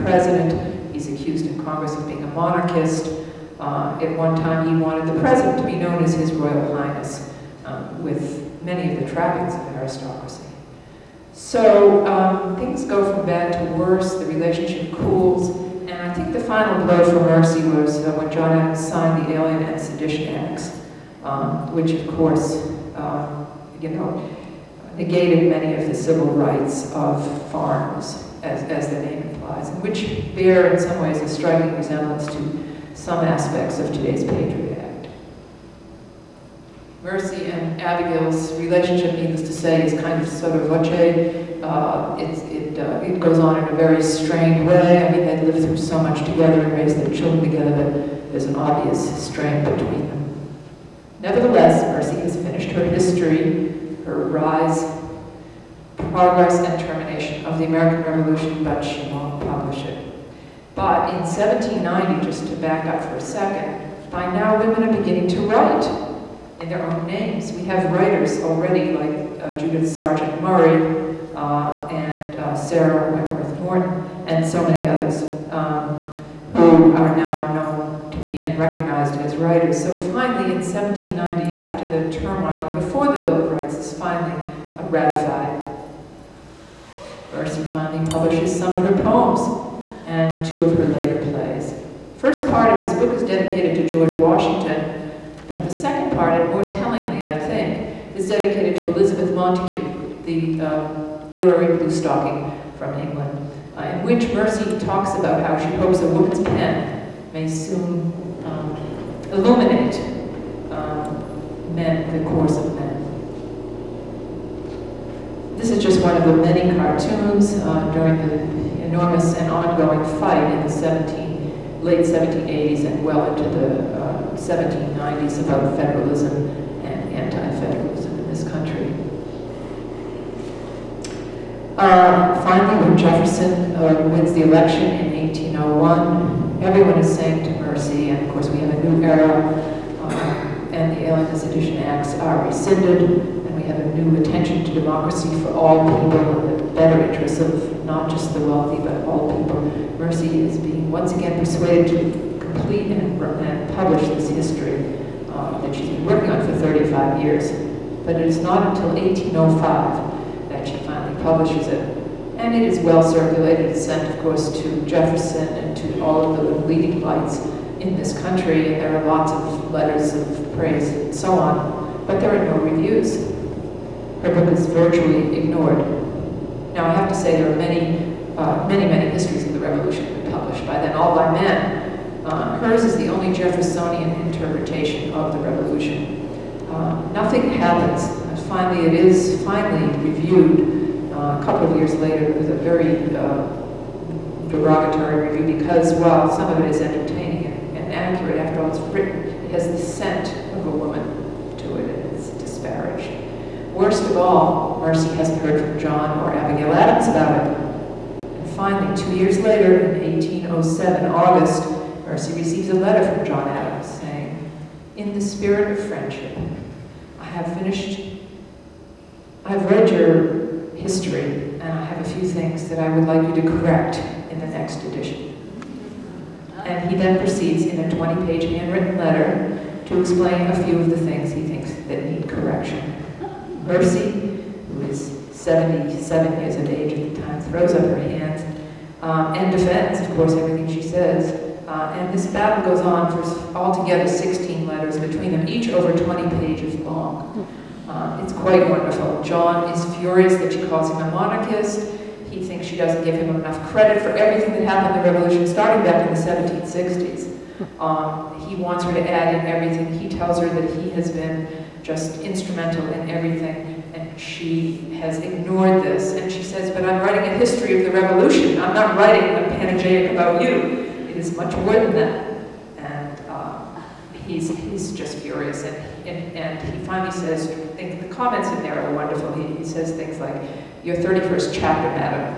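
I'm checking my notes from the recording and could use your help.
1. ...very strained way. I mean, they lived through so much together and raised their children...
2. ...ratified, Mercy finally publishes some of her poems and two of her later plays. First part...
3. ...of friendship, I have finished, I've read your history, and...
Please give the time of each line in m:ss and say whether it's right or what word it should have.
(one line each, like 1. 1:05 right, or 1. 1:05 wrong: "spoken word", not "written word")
1. 0:43 right
2. 1:24 right
3. 3:35 right.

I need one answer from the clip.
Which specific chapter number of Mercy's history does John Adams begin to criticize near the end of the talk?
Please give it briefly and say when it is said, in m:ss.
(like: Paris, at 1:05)
31st, at 4:40.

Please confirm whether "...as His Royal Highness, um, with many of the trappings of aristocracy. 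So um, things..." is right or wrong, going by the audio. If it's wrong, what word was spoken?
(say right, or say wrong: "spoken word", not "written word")
right.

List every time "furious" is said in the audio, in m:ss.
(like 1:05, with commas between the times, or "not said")
4:09, 4:35.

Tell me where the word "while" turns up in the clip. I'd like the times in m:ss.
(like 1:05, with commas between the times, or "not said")
3:15.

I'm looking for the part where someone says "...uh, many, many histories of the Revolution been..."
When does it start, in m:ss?
2:58.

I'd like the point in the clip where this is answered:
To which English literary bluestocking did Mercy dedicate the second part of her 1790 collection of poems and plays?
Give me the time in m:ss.
1:38.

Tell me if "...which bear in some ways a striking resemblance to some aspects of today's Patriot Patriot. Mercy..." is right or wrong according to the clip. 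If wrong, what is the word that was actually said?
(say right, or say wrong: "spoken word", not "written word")
wrong: "Act", not "Patriot".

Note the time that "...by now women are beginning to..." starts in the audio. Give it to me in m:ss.
1:04.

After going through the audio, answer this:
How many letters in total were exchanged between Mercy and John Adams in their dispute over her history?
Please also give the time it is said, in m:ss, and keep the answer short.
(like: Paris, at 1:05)
16, at 4:04.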